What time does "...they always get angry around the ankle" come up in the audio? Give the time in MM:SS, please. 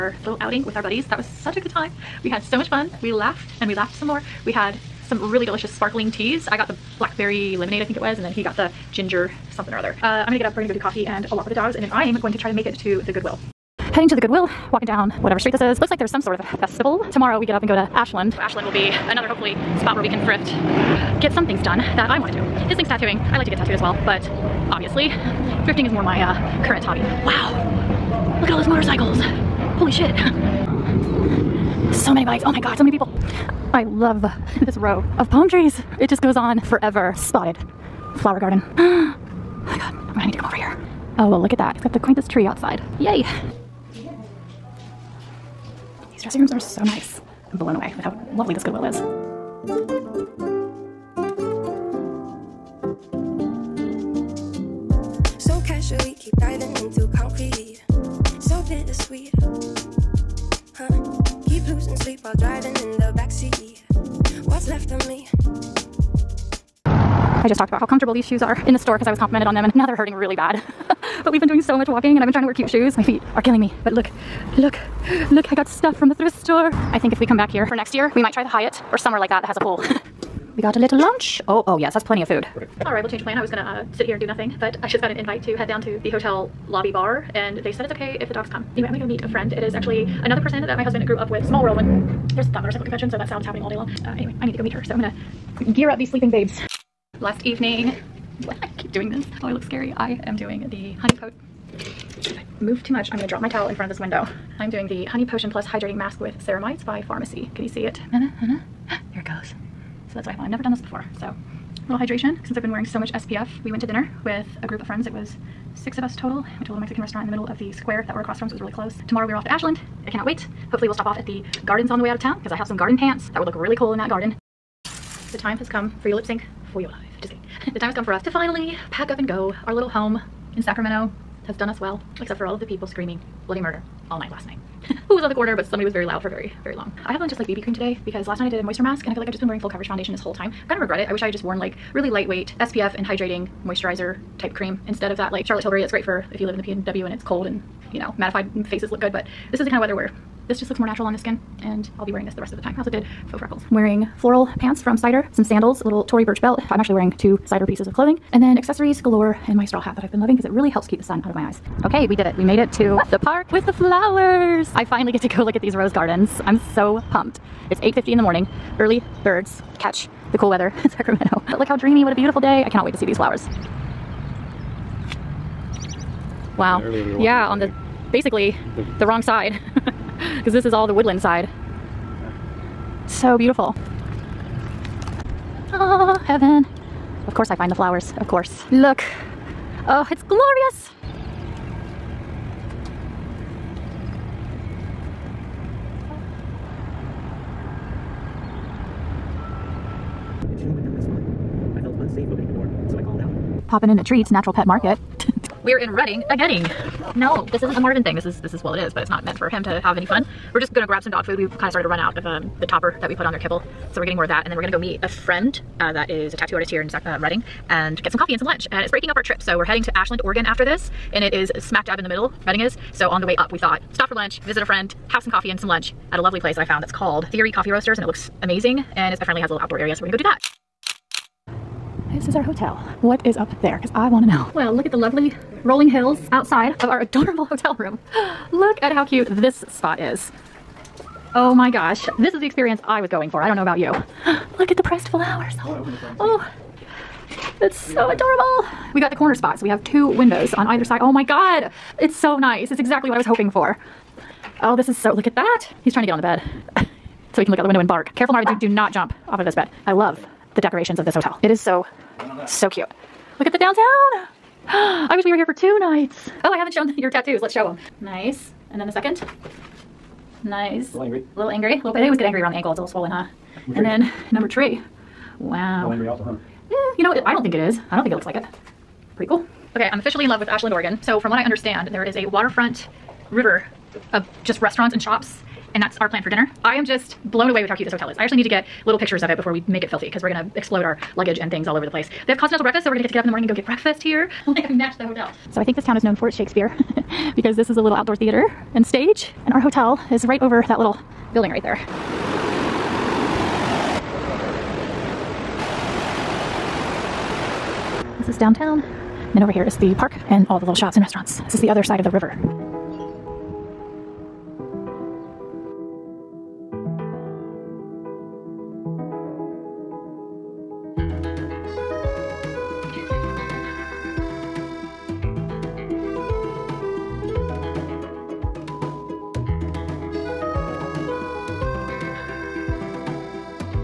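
04:31.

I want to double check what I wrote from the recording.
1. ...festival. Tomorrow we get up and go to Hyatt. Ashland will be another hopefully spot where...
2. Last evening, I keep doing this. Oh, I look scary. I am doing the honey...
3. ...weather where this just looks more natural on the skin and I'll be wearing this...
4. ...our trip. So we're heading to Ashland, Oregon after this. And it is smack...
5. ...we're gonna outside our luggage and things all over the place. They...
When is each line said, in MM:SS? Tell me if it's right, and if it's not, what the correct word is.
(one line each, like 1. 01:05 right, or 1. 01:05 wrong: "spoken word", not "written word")
1. 00:16 wrong: "Ashland", not "Hyatt"
2. 01:37 right
3. 02:29 right
4. 03:39 right
5. 04:50 wrong: "explode", not "outside".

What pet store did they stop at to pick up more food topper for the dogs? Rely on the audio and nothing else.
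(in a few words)
Treats Natural Pet Market.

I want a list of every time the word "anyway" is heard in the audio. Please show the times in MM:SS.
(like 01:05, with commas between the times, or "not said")
01:28, 01:34.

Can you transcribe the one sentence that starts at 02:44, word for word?
I finally get to go look at these rose gardens.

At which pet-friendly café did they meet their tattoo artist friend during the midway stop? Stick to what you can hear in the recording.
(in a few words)
Theory Coffee Roasters.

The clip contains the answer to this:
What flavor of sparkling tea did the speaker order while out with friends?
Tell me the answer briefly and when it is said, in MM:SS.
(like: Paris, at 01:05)
Blackberry lemonade, at 00:06.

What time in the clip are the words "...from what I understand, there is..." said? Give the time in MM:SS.
04:41.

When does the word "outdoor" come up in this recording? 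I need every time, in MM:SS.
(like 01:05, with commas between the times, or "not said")
03:49, 04:57.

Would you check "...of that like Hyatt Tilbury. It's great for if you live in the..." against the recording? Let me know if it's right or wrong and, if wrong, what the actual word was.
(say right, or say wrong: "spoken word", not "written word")
wrong: "Charlotte", not "Hyatt".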